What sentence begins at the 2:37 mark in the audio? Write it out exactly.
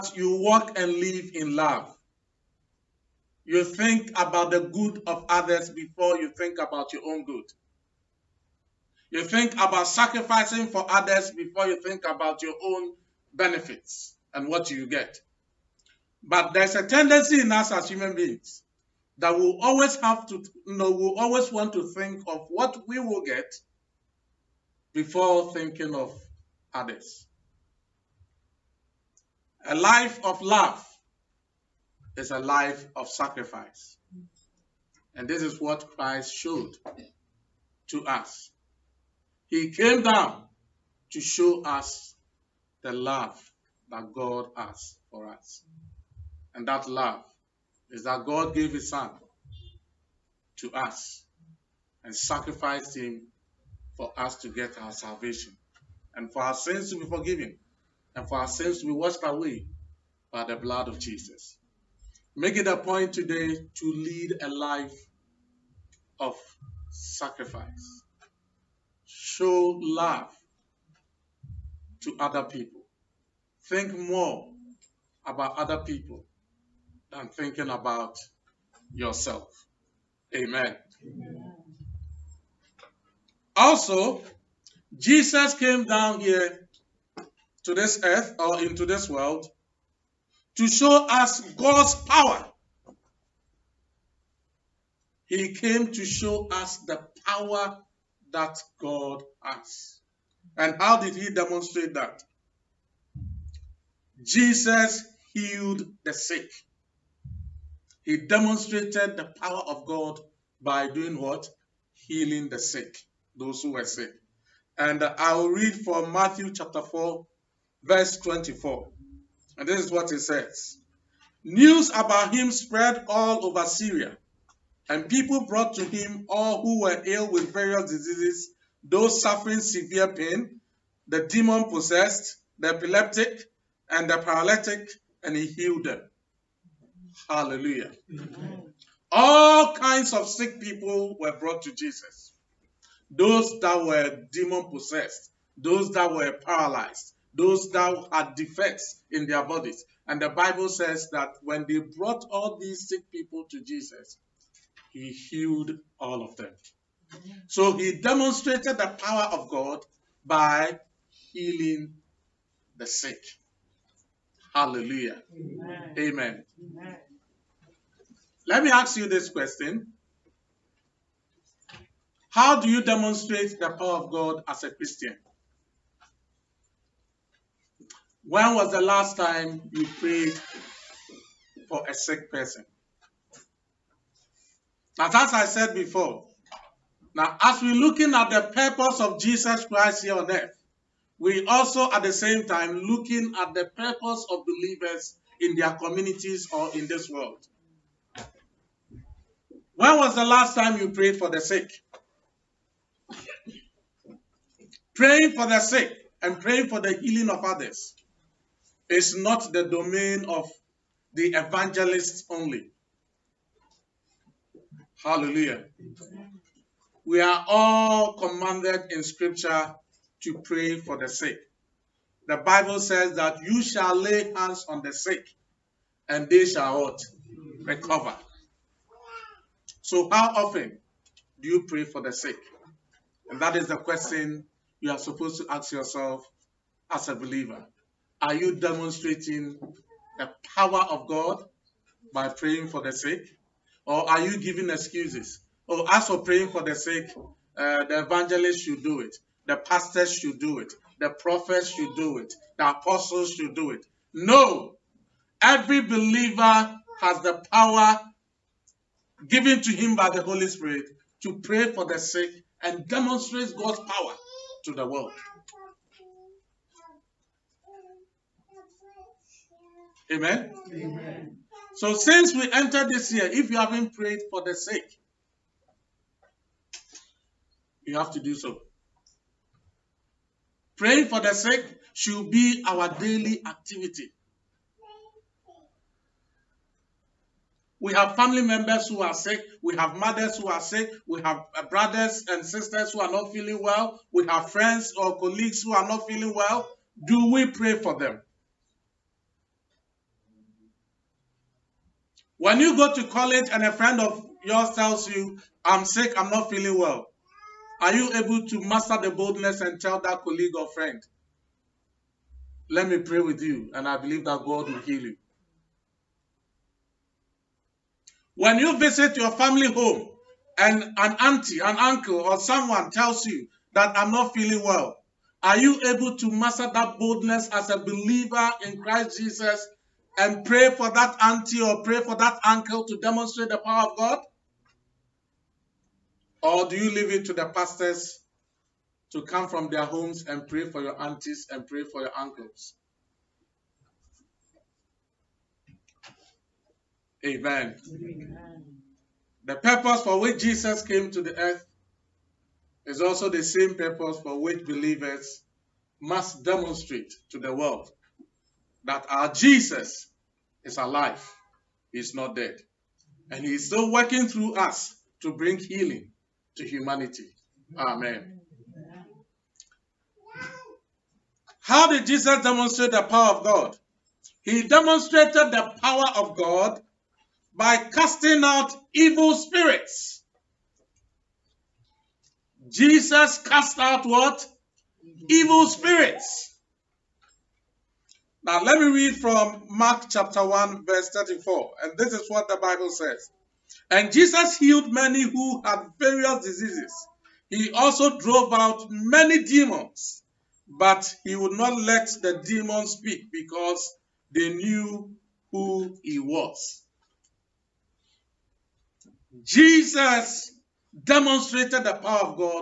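So he demonstrated the power of God by healing the sick.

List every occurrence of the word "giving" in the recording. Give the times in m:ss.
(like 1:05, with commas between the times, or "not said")
4:04.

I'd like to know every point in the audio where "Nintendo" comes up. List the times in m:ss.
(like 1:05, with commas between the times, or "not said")
not said.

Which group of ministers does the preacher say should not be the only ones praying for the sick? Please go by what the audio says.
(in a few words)
the evangelists.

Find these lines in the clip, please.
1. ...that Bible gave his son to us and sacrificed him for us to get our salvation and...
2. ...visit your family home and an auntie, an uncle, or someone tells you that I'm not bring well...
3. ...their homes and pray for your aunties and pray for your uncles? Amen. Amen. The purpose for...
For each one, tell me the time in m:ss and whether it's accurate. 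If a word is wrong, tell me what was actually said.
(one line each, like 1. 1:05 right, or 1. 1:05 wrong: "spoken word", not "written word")
1. 0:48 wrong: "God", not "Bible"
2. 5:18 wrong: "feeling", not "bring"
3. 5:39 right.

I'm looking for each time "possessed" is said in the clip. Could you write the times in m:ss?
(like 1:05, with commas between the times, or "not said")
2:11, 2:24.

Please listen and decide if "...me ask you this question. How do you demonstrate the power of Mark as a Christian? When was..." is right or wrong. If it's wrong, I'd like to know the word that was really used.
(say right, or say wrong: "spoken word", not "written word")
wrong: "God", not "Mark".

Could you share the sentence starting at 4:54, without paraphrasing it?
We have friends or colleagues who are not feeling well.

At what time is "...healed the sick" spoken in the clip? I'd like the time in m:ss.
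1:45.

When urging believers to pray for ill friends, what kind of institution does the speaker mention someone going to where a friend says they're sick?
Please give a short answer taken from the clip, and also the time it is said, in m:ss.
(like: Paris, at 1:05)
college, at 5:03.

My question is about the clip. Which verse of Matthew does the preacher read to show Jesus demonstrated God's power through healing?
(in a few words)
Matthew 4:24.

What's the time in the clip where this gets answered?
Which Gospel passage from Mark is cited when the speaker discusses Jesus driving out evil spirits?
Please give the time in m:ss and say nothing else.
6:29.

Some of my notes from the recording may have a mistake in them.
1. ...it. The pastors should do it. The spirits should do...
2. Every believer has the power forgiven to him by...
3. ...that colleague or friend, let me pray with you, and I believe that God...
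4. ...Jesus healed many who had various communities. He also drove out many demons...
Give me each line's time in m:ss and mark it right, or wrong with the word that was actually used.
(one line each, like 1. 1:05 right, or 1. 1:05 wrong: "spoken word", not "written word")
1. 4:09 wrong: "prophets", not "spirits"
2. 4:15 wrong: "given", not "forgiven"
3. 5:10 right
4. 6:34 wrong: "diseases", not "communities".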